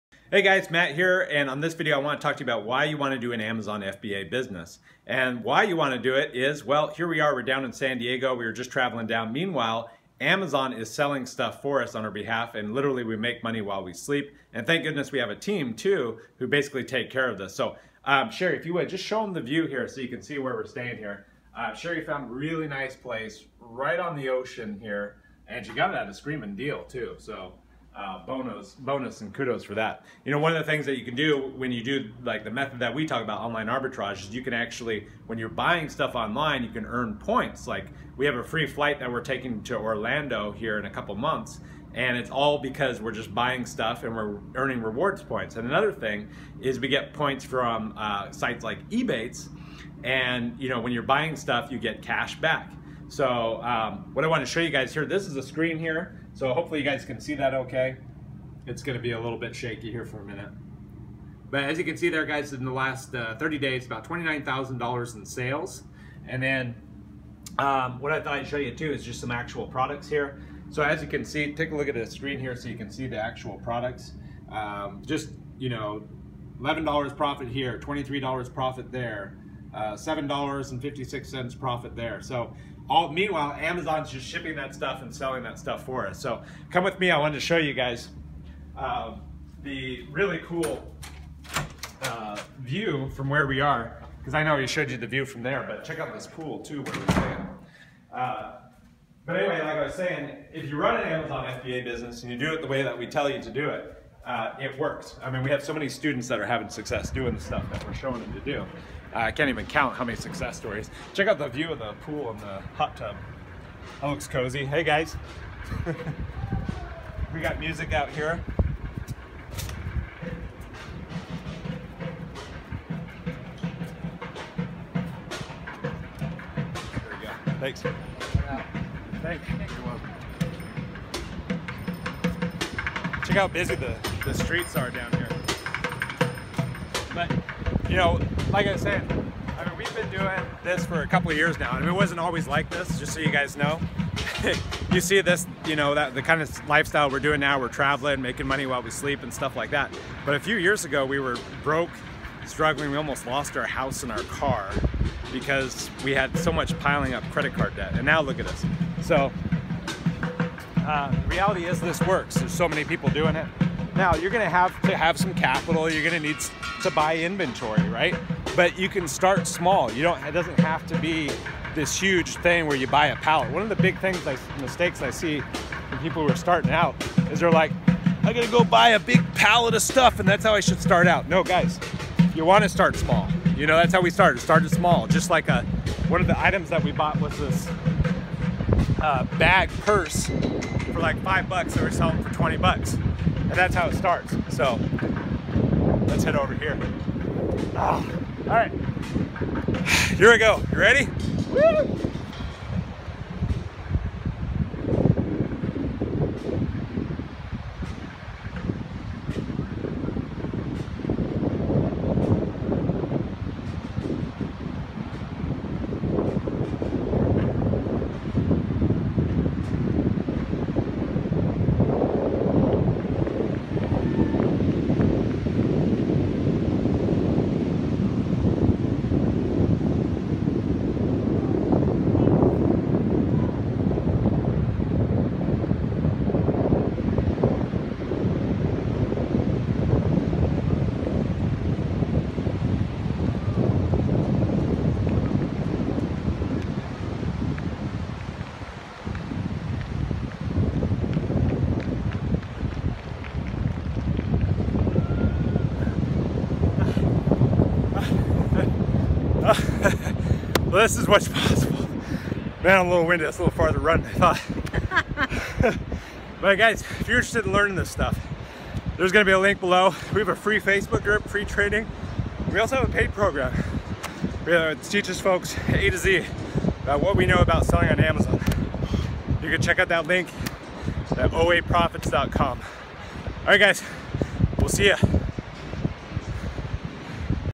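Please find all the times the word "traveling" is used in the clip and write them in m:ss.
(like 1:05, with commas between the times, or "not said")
0:08, 2:27.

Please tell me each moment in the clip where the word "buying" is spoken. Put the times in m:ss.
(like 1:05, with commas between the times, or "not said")
0:35, 0:43, 0:51.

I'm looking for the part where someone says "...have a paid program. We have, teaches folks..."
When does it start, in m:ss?
4:32.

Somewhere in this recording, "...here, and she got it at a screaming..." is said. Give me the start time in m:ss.
0:24.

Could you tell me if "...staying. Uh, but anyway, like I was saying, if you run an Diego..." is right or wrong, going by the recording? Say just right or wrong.
wrong.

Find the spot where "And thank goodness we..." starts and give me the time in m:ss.
0:14.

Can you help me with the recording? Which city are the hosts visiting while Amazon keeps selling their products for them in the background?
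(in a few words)
San Diego.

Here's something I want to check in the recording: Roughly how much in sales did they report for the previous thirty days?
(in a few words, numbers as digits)
$29,000.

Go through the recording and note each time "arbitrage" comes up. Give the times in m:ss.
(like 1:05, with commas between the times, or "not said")
0:33.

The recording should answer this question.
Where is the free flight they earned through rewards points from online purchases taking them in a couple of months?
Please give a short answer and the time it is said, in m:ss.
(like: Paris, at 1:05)
Orlando, at 0:39.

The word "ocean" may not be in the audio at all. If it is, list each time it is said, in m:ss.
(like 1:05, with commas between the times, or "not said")
0:24.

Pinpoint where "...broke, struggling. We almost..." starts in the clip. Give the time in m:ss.
2:31.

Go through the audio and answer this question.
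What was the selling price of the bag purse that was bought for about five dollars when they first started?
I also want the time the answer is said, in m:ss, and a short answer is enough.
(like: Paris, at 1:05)
$20, at 3:12.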